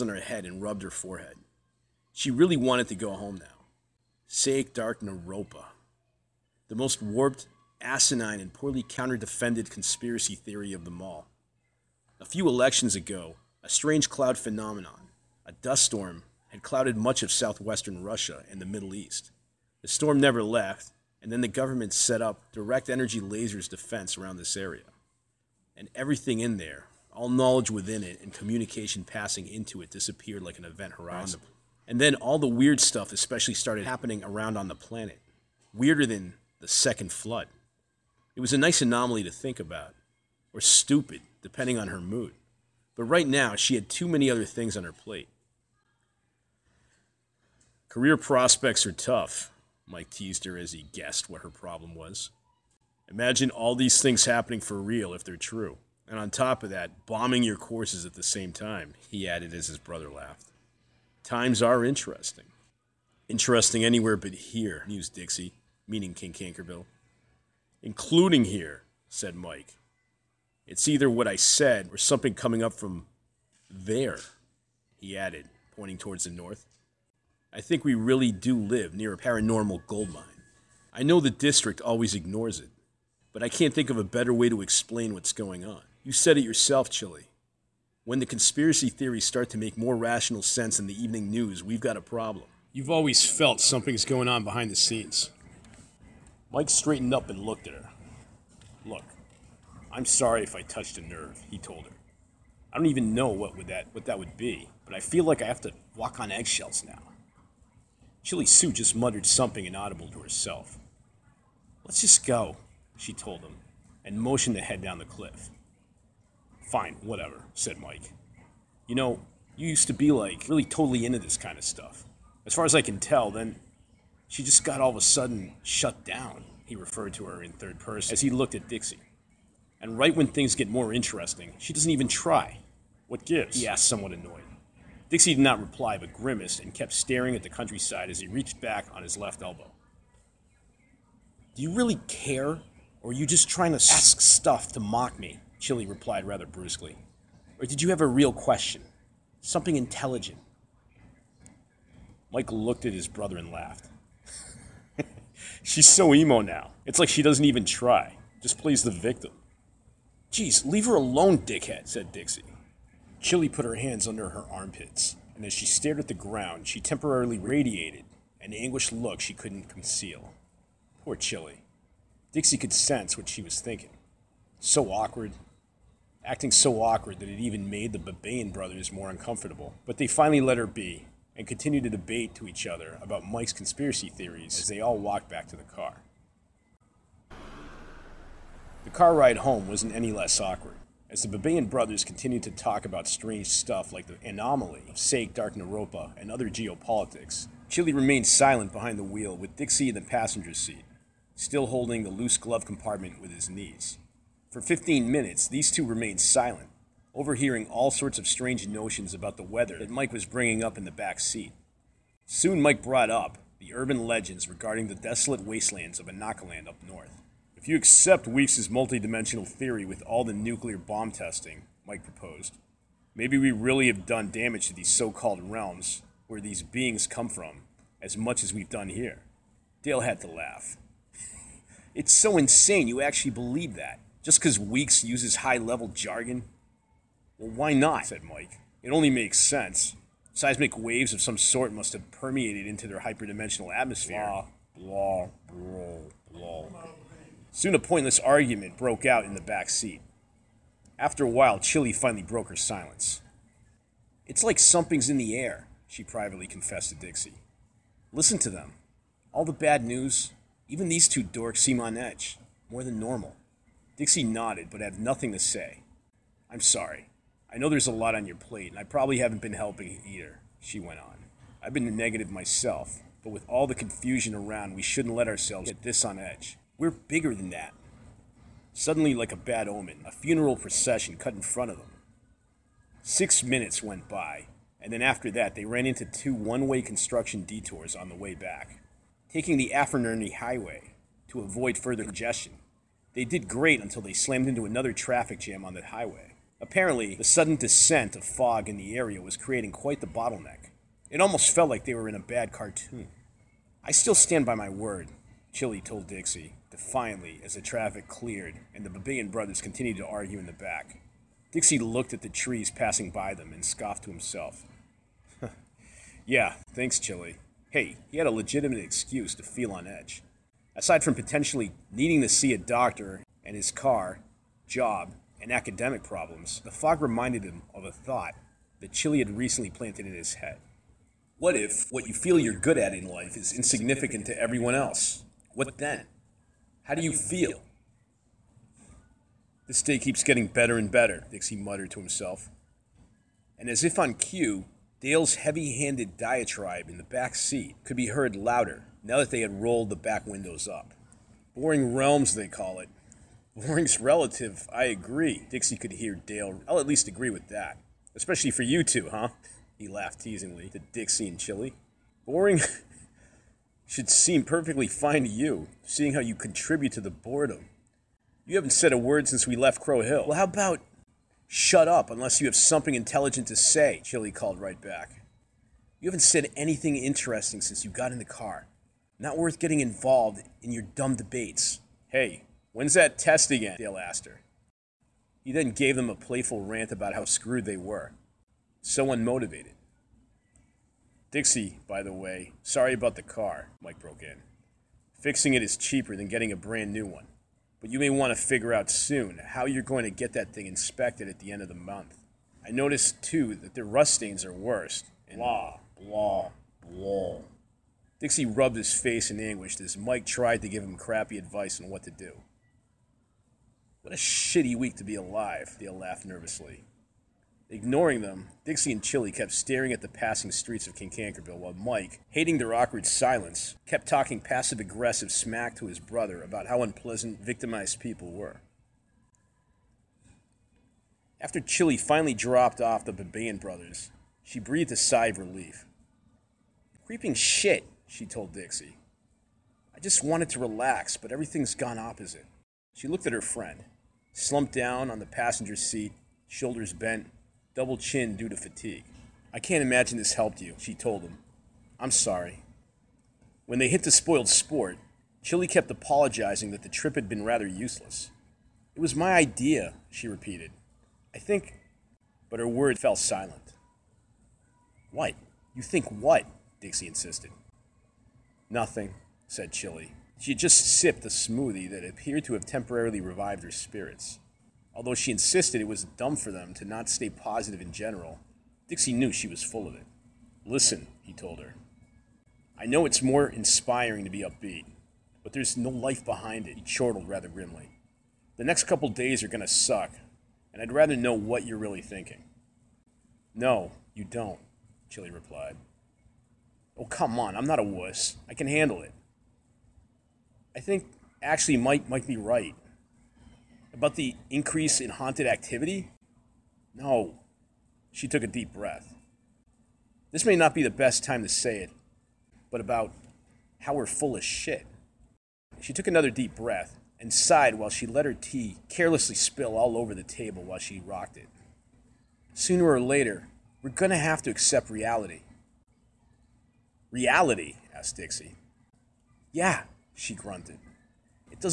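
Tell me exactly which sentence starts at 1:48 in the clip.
Chili Sue just muttered something inaudible to herself.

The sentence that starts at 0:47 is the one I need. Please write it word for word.
Career prospects are tough, Mike teased her as he guessed what her problem was.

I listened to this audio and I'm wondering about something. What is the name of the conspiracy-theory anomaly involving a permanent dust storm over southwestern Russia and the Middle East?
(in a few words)
Saic Dark Naropa.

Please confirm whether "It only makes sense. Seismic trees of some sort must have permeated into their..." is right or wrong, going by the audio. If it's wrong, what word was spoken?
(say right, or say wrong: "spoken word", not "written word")
wrong: "waves", not "trees".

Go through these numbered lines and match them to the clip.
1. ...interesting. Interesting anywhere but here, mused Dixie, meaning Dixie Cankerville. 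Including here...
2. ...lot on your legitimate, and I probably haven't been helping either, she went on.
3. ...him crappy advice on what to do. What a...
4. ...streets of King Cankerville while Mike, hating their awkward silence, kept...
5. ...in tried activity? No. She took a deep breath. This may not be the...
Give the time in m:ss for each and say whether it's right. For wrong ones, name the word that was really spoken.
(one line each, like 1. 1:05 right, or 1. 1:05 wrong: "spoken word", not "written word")
1. 1:01 wrong: "King", not "Dixie"
2. 4:27 wrong: "plate", not "legitimate"
3. 6:50 right
4. 7:00 right
5. 8:25 wrong: "haunted", not "tried".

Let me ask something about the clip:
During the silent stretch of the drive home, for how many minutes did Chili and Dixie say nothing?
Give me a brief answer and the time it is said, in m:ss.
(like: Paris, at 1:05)
15, at 3:24.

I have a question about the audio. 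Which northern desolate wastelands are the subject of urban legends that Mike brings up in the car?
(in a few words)
Anakaland.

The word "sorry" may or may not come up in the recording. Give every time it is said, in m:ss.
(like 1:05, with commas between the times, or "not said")
1:40, 4:26, 6:32, 7:32.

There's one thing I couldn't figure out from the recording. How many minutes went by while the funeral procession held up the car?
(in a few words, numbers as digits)
6.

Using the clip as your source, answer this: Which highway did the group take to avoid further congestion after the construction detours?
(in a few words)
Afernerney Highway.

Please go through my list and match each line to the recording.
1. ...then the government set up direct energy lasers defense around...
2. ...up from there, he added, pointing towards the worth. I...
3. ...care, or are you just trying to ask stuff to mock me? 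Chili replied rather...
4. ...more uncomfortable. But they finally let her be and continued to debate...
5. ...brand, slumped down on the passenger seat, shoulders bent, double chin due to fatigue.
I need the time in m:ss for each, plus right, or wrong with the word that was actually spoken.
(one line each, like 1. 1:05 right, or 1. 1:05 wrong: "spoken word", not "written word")
1. 0:21 right
2. 1:12 wrong: "north", not "worth"
3. 2:22 right
4. 2:58 right
5. 7:23 wrong: "friend", not "brand".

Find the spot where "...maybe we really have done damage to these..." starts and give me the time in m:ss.
3:43.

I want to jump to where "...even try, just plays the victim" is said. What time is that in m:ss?
2:37.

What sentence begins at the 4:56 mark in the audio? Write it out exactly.
Apparently, the sudden descent of fog in the area was creating quite the bottleneck.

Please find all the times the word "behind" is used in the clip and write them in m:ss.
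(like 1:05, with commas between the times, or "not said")
1:34, 3:18, 8:06.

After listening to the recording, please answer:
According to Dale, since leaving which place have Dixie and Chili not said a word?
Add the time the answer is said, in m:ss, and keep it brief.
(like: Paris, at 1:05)
Crow Hill, at 6:09.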